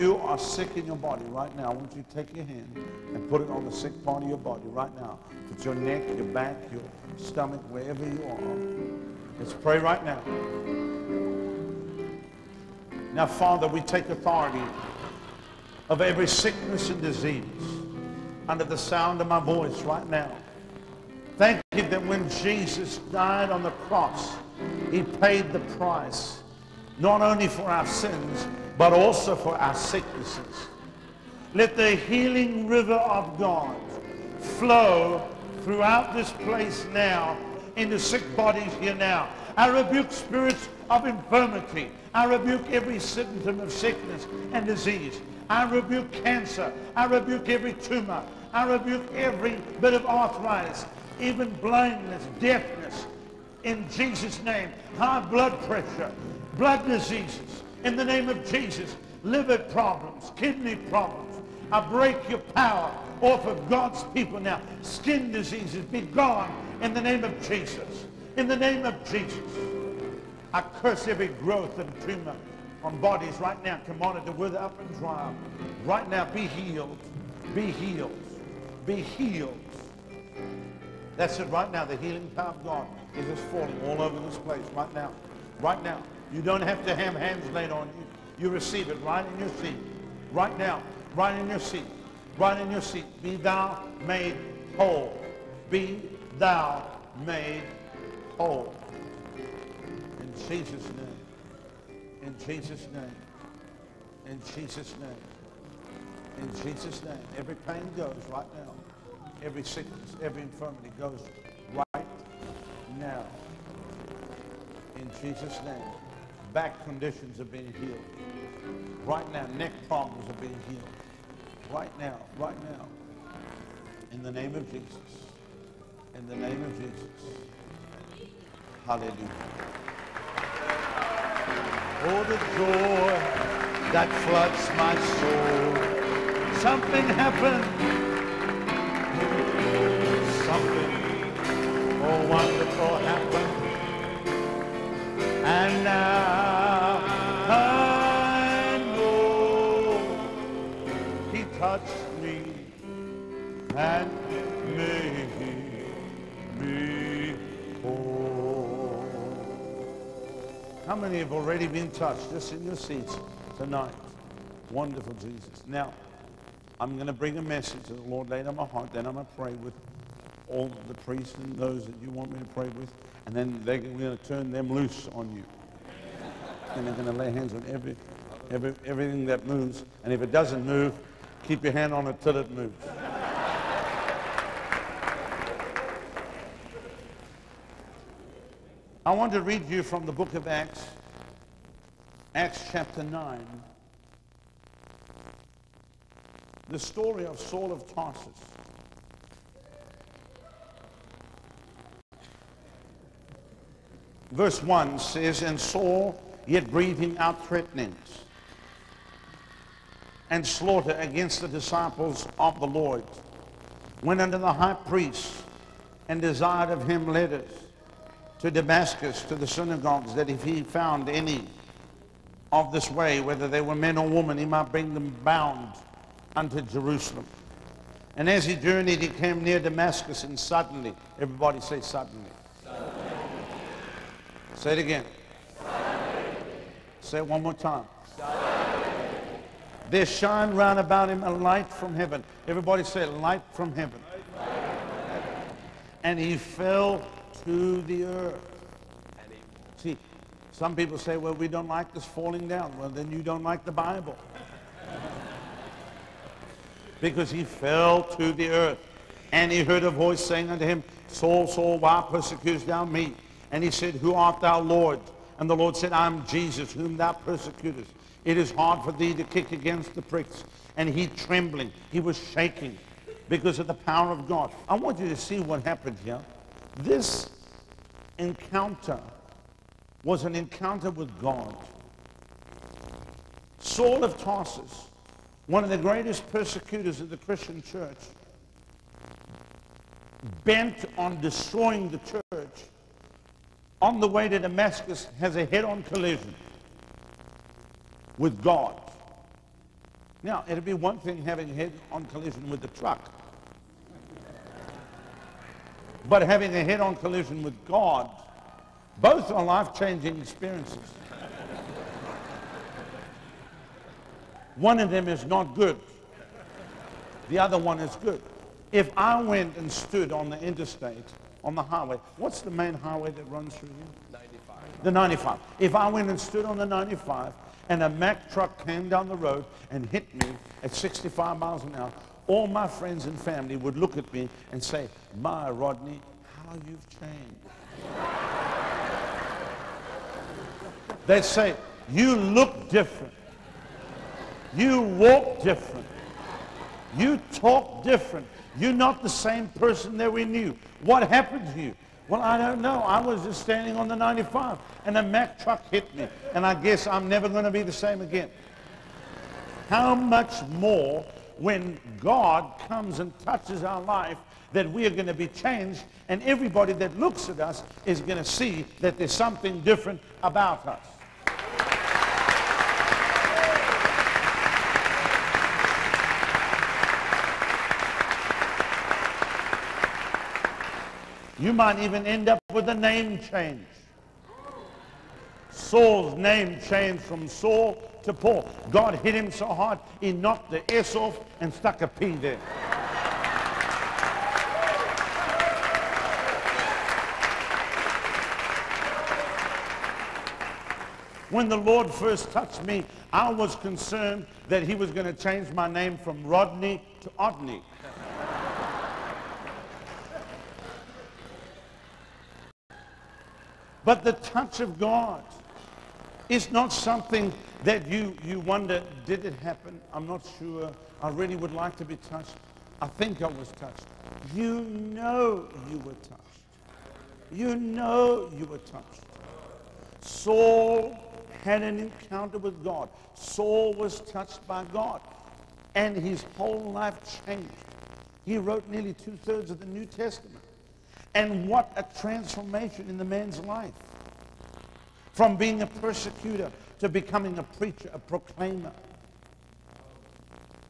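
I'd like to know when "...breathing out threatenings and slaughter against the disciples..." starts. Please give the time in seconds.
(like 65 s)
206 s.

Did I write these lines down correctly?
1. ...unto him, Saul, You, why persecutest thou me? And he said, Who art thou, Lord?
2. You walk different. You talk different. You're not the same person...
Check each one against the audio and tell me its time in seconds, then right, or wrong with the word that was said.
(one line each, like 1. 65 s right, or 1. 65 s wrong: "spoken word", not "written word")
1. 260 s wrong: "Saul", not "You"
2. 344 s right.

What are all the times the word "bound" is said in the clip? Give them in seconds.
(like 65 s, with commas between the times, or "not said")
225 s.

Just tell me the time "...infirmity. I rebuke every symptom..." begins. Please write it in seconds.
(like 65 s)
41 s.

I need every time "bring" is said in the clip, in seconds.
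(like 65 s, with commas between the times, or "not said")
167 s, 224 s.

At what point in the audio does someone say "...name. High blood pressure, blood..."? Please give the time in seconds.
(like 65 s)
54 s.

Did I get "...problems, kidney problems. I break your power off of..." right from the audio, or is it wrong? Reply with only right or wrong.
right.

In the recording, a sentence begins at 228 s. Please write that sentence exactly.
And as he journeyed, he came near Damascus, and suddenly, everybody say suddenly.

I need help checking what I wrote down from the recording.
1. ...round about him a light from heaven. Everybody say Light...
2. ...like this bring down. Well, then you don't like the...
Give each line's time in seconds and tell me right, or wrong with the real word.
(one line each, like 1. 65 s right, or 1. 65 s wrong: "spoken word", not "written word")
1. 240 s right
2. 251 s wrong: "falling", not "bring".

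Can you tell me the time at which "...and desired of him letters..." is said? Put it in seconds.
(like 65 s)
216 s.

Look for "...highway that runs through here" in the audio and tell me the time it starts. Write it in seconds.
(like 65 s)
322 s.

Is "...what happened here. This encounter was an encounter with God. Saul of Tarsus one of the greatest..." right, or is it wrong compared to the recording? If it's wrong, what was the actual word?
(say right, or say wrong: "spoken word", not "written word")
right.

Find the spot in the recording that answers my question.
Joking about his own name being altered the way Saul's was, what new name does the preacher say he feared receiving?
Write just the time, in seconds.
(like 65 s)
407 s.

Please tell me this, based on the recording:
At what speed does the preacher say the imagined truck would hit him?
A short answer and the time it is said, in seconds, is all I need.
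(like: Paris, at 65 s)
65 miles an hour, at 330 s.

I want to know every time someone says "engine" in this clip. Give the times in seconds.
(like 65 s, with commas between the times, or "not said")
not said.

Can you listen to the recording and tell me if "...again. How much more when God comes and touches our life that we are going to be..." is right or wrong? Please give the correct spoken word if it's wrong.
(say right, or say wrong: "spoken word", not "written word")
right.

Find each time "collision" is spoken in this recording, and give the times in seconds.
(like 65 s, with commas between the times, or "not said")
295 s, 302 s, 306 s.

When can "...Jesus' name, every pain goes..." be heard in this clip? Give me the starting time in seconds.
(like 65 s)
106 s.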